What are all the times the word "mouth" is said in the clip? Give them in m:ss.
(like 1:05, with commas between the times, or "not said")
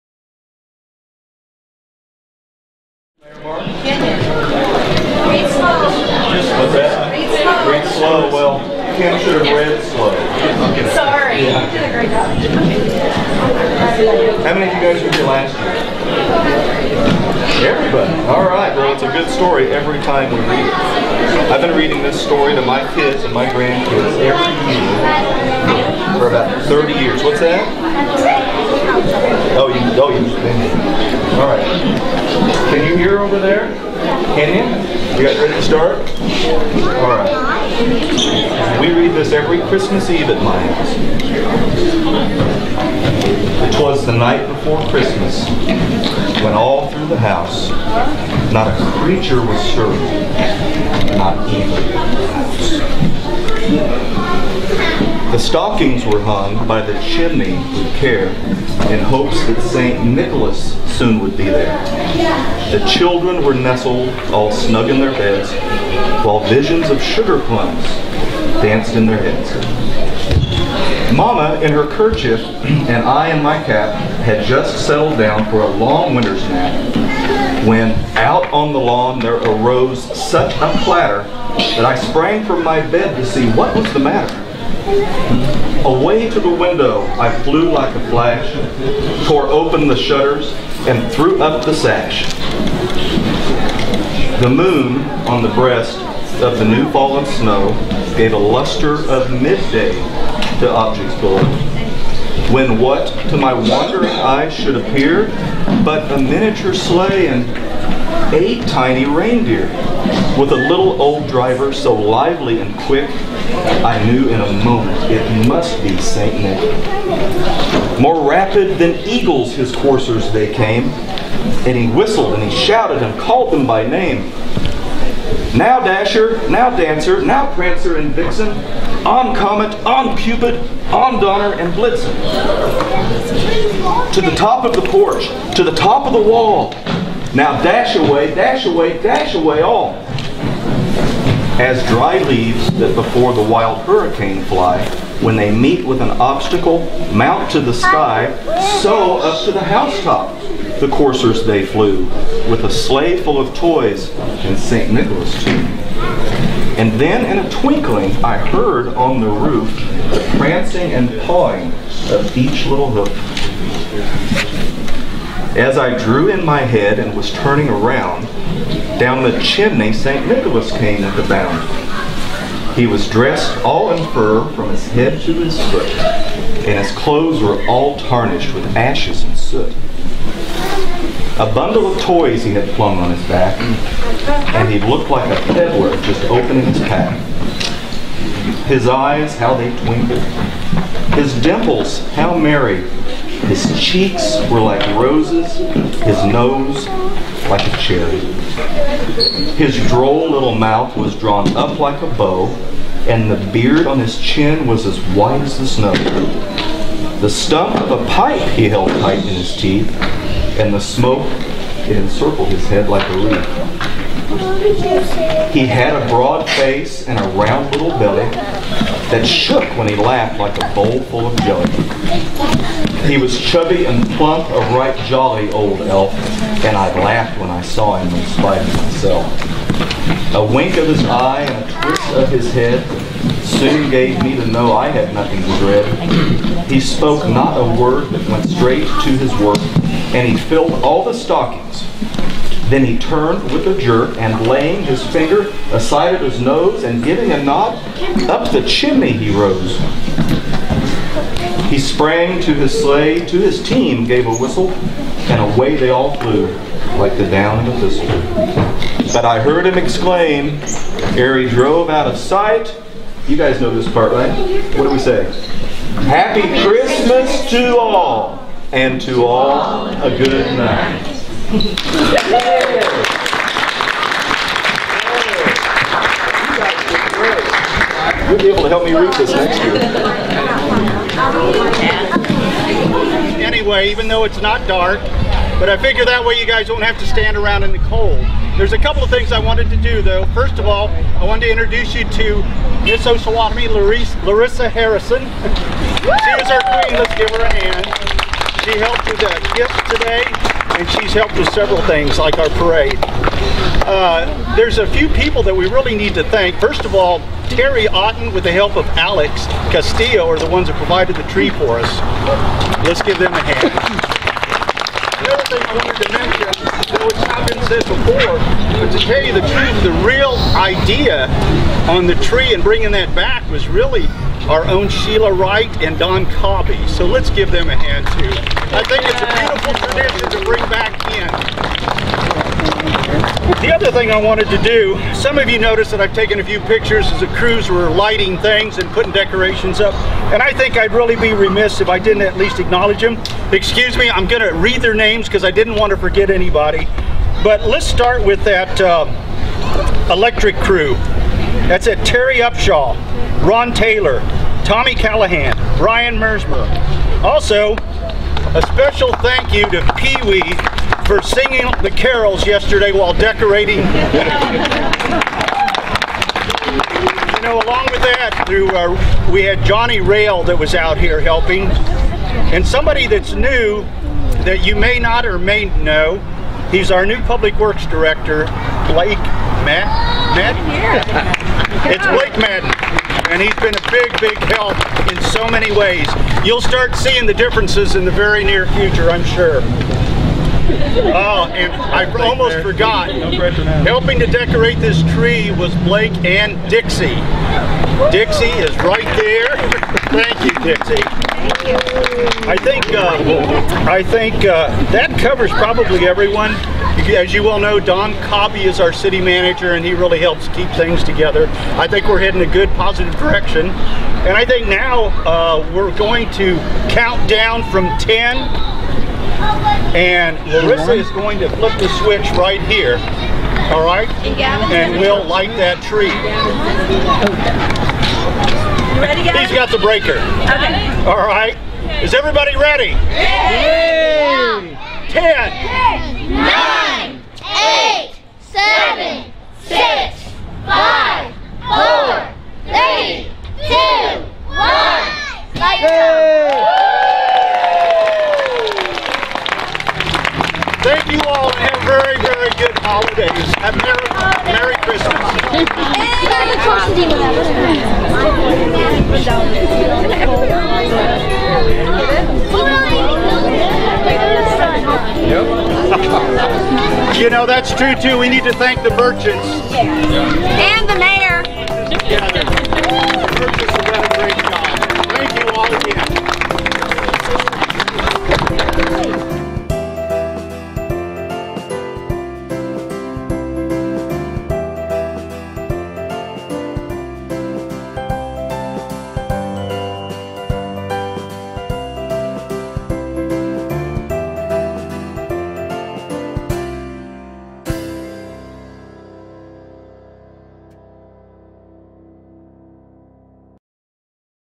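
3:20.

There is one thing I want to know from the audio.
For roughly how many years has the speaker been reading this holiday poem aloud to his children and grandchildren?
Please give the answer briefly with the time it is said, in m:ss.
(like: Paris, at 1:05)
30, at 0:26.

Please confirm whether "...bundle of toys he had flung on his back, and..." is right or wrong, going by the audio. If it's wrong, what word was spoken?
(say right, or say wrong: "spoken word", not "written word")
right.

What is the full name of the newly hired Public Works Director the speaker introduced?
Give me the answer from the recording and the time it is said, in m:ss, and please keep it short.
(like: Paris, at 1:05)
Blake Madden, at 6:22.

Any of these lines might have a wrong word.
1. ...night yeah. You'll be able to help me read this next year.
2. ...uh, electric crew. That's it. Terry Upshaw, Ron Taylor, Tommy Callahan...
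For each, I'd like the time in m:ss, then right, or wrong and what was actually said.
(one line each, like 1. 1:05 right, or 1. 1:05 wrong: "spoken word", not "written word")
1. 4:30 right
2. 5:48 right.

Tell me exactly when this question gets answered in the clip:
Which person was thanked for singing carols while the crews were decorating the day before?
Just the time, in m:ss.
5:59.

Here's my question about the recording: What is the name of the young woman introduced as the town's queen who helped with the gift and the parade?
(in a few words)
Larissa Harrison.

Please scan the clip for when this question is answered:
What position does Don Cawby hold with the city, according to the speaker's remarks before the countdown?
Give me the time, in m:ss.
6:48.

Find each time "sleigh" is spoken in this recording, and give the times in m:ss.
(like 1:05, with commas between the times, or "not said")
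1:46, 2:32, 4:12.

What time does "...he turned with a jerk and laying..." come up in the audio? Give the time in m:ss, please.
4:02.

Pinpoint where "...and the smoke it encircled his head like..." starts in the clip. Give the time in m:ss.
3:30.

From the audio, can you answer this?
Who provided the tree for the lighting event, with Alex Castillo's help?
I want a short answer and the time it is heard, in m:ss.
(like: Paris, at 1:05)
Terry Otten, at 5:07.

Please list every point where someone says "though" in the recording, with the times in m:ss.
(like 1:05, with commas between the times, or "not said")
4:44, 4:50, 5:16.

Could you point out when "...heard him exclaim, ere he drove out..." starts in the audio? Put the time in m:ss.
4:19.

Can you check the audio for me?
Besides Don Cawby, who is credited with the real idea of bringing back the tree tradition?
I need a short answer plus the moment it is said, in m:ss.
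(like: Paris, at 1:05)
Sheila Wright, at 5:24.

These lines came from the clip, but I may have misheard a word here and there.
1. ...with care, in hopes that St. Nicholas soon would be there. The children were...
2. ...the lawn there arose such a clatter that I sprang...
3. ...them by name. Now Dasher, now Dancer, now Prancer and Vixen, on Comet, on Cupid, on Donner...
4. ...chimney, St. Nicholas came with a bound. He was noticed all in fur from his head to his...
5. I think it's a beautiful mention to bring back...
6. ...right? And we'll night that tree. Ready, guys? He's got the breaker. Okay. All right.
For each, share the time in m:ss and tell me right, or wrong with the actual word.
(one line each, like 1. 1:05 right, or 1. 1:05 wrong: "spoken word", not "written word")
1. 0:57 right
2. 1:18 right
3. 2:03 right
4. 2:49 wrong: "dressed", not "noticed"
5. 5:28 wrong: "tradition", not "mention"
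6. 7:03 wrong: "light", not "night".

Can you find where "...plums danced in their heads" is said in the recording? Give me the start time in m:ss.
1:07.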